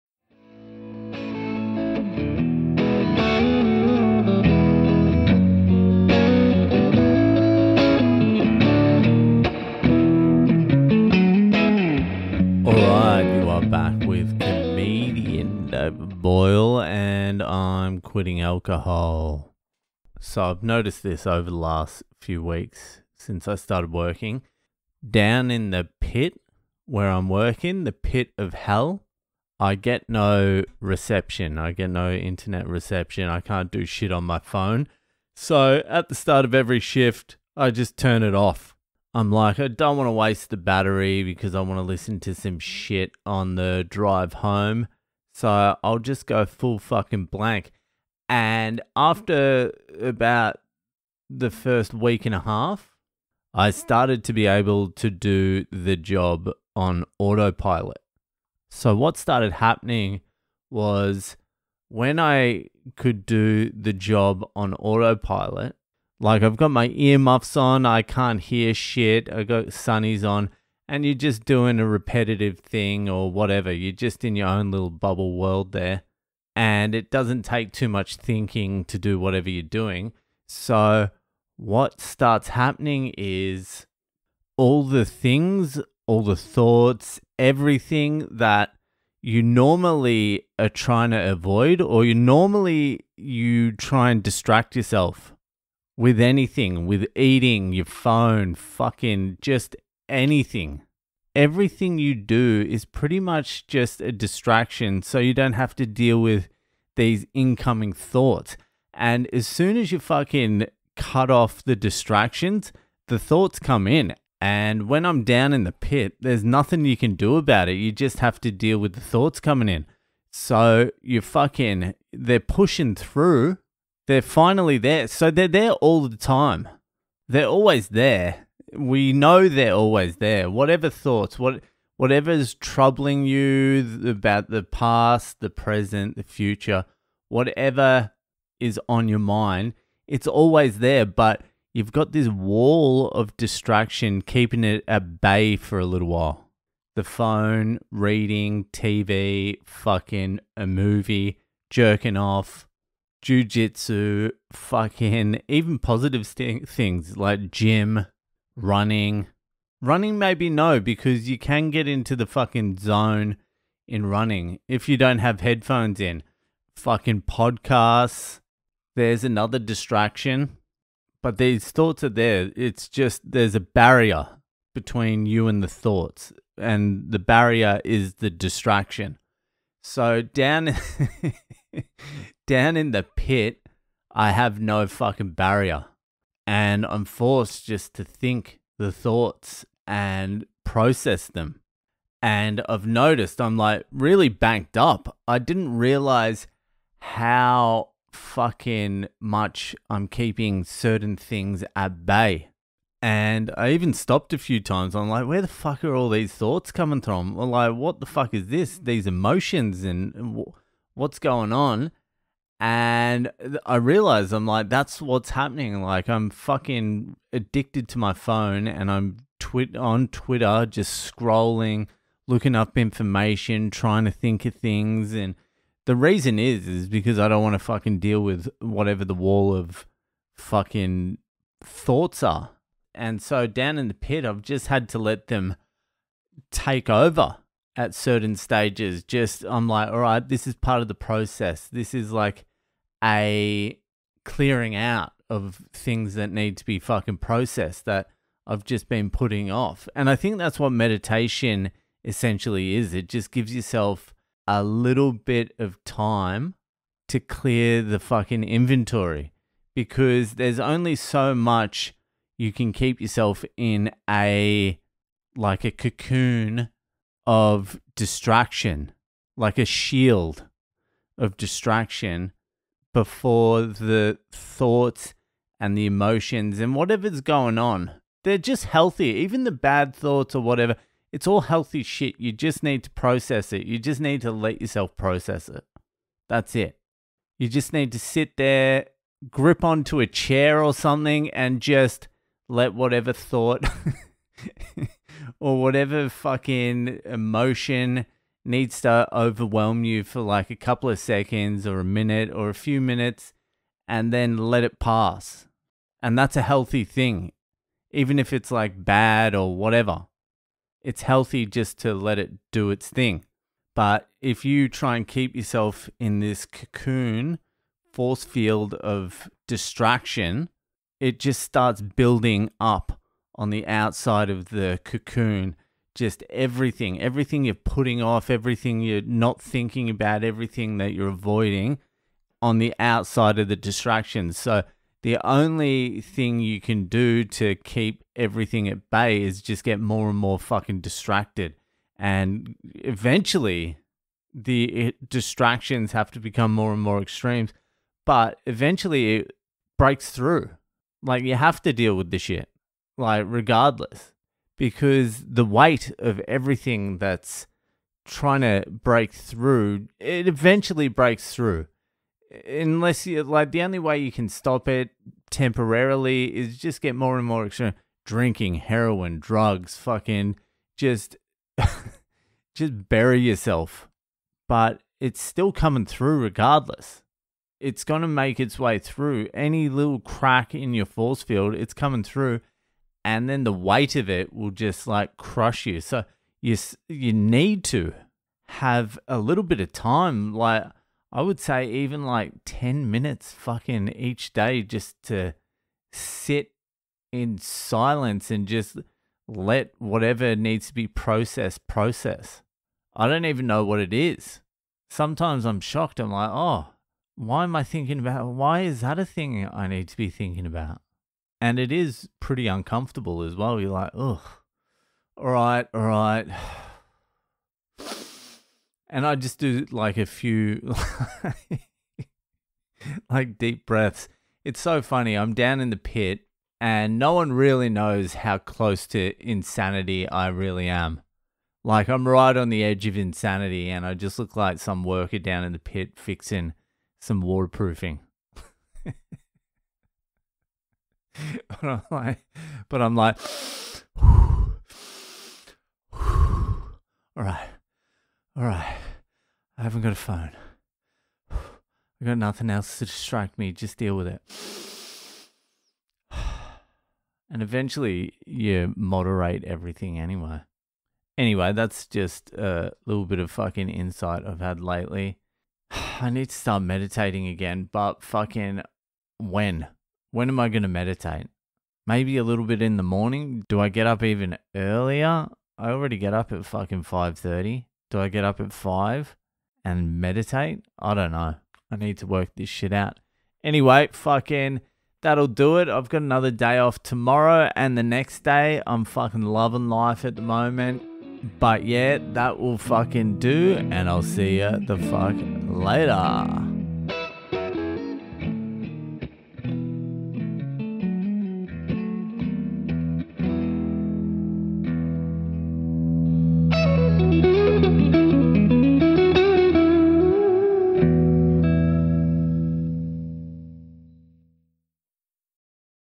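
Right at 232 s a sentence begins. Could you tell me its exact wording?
And so down in the pit, I've just had to let them take over at certain stages.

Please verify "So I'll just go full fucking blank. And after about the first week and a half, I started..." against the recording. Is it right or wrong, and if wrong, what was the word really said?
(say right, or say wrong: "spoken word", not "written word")
right.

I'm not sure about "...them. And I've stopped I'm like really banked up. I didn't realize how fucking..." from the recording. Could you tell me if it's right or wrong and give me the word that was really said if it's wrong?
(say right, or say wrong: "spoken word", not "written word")
wrong: "noticed", not "stopped".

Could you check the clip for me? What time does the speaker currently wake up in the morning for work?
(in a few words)
5:30.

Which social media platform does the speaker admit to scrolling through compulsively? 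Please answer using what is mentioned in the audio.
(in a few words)
Twitter.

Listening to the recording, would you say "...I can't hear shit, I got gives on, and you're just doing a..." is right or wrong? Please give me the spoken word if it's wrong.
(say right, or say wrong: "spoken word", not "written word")
wrong: "sunnies", not "gives".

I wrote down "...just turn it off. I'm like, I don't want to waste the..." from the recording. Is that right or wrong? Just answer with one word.
right.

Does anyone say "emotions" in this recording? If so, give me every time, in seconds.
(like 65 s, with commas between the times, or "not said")
209 s, 275 s, 297 s.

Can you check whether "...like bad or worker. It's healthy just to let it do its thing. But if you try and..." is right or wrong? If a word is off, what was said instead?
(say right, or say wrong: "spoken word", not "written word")
wrong: "whatever", not "worker".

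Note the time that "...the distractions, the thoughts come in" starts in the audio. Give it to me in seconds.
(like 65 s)
111 s.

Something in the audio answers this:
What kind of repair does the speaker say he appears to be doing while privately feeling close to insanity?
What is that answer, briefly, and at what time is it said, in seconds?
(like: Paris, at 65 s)
Waterproofing, at 437 s.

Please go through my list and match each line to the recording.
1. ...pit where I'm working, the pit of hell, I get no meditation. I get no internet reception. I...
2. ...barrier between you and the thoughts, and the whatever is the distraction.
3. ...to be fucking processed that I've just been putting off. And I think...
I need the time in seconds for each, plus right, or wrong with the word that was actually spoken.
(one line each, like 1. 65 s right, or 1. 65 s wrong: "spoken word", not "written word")
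1. 25 s wrong: "reception", not "meditation"
2. 173 s wrong: "barrier", not "whatever"
3. 246 s right.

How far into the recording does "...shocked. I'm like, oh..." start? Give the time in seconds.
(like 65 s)
405 s.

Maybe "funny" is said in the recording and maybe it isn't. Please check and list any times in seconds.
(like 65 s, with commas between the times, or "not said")
424 s.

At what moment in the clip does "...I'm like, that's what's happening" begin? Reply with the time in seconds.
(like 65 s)
214 s.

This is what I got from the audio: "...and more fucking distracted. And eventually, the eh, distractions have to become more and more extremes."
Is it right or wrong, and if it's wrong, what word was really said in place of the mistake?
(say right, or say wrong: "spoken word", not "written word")
right.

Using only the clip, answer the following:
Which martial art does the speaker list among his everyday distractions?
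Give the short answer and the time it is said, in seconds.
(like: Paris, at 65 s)
Jujitsu, at 153 s.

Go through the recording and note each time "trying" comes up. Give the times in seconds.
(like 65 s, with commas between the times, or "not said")
90 s, 223 s, 358 s.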